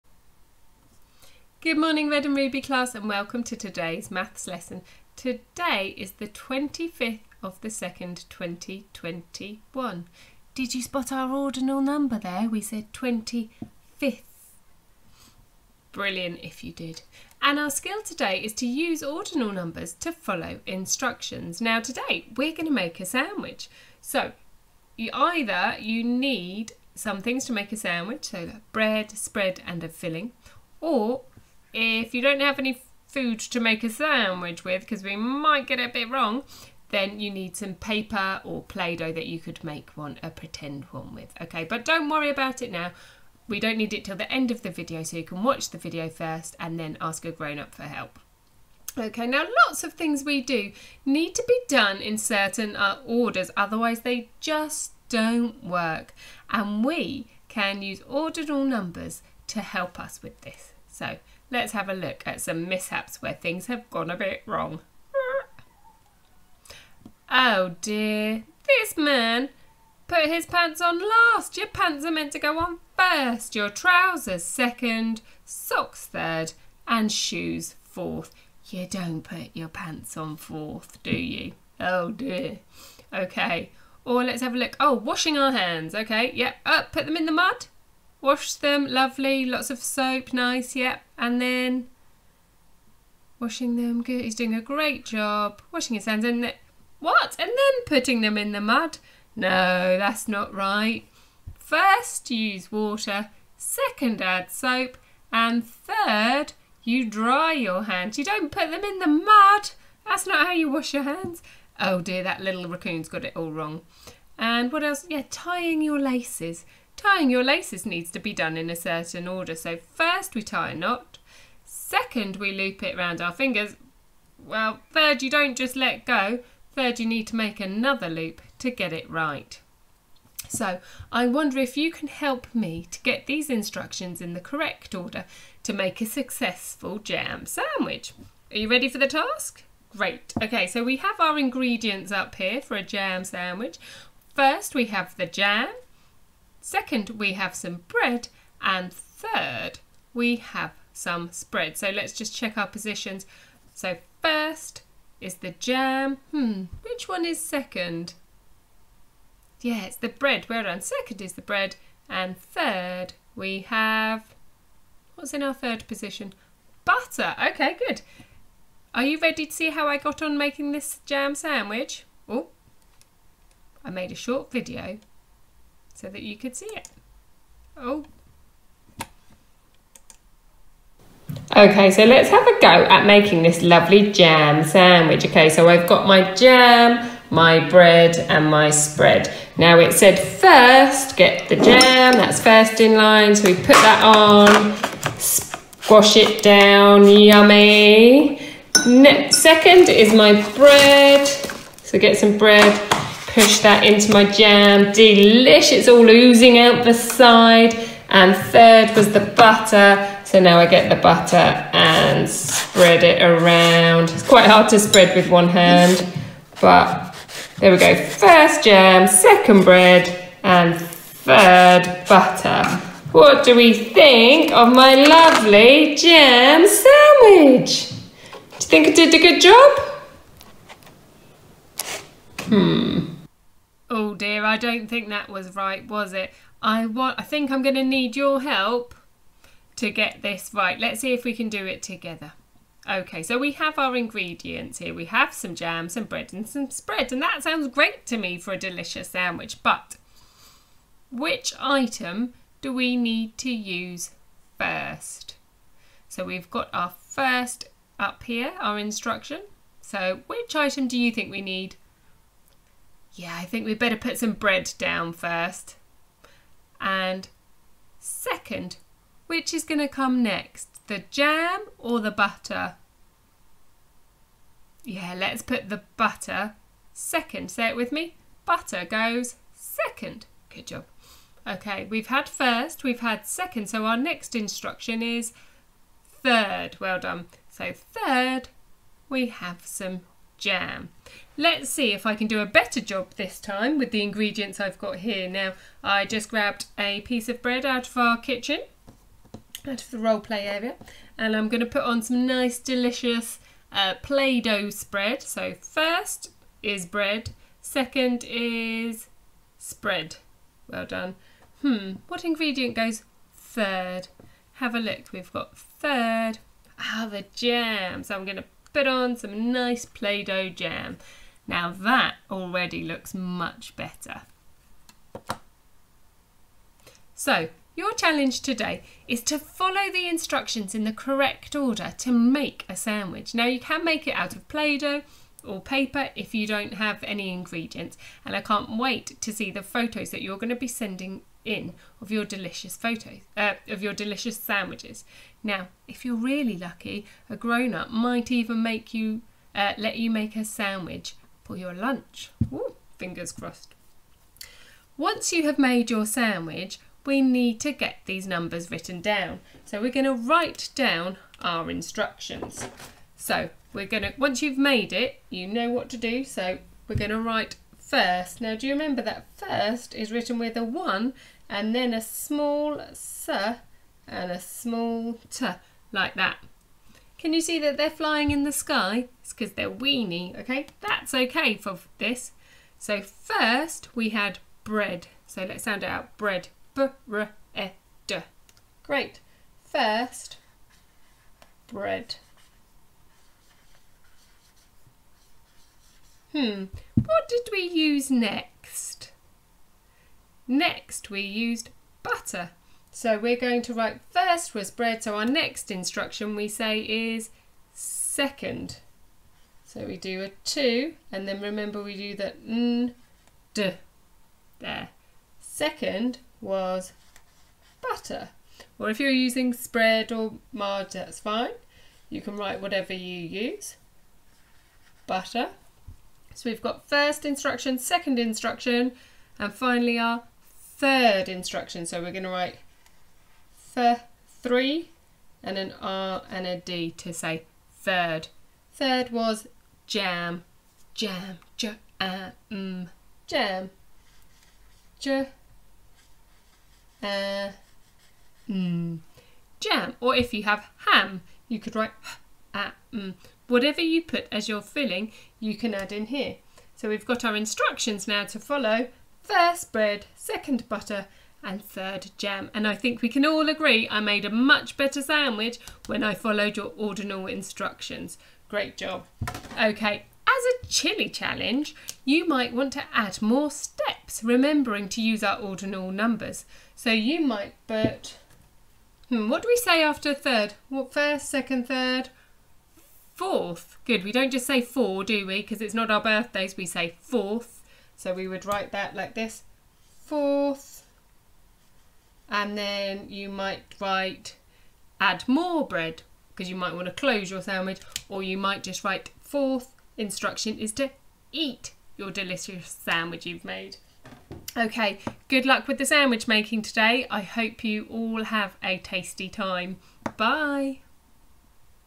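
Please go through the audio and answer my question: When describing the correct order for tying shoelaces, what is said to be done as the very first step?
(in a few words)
tie a knot.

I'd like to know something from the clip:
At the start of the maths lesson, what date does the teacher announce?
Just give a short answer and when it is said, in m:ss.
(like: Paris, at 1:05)
25th of the 2nd 2021, at 0:06.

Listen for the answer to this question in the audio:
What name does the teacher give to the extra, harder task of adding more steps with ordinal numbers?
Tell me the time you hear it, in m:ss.
7:50.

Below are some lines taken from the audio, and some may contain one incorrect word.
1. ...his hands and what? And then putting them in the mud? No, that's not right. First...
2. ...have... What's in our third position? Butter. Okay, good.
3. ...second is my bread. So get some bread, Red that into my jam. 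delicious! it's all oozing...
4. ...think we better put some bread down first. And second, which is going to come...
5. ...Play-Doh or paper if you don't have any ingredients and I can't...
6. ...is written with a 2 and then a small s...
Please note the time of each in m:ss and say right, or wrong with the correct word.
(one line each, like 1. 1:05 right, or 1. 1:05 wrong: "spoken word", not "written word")
1. 1:35 right
2. 2:43 right
3. 3:19 wrong: "Push", not "Red"
4. 4:23 right
5. 5:34 right
6. 6:09 wrong: "1", not "2".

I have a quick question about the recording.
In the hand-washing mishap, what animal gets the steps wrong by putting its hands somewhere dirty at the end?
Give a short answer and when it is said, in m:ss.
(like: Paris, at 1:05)
raccoon, at 1:52.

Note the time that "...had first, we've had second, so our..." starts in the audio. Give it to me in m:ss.
4:42.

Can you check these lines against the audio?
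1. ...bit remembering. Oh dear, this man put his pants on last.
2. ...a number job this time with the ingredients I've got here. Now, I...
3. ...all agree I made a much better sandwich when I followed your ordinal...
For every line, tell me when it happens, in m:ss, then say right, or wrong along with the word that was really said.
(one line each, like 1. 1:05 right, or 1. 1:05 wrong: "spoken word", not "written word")
1. 1:04 wrong: "wrong", not "remembering"
2. 4:52 wrong: "better", not "number"
3. 7:43 right.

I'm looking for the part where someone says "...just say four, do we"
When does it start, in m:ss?
8:04.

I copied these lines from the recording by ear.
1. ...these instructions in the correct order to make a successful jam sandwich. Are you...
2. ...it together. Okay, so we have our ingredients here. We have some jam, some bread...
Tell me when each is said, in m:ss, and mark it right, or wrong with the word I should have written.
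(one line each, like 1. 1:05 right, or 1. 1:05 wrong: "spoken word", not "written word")
1. 2:13 right
2. 4:01 right.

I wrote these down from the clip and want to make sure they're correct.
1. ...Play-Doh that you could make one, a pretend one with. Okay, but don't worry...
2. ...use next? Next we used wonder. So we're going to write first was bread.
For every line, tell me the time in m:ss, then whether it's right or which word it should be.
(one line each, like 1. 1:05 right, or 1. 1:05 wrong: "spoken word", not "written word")
1. 0:38 right
2. 6:37 wrong: "butter", not "wonder".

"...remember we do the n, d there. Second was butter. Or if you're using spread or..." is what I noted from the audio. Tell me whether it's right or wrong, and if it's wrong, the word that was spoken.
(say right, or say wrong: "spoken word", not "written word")
right.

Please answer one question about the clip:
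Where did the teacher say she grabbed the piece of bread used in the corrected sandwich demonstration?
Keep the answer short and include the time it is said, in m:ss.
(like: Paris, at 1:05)
the role play area, at 4:59.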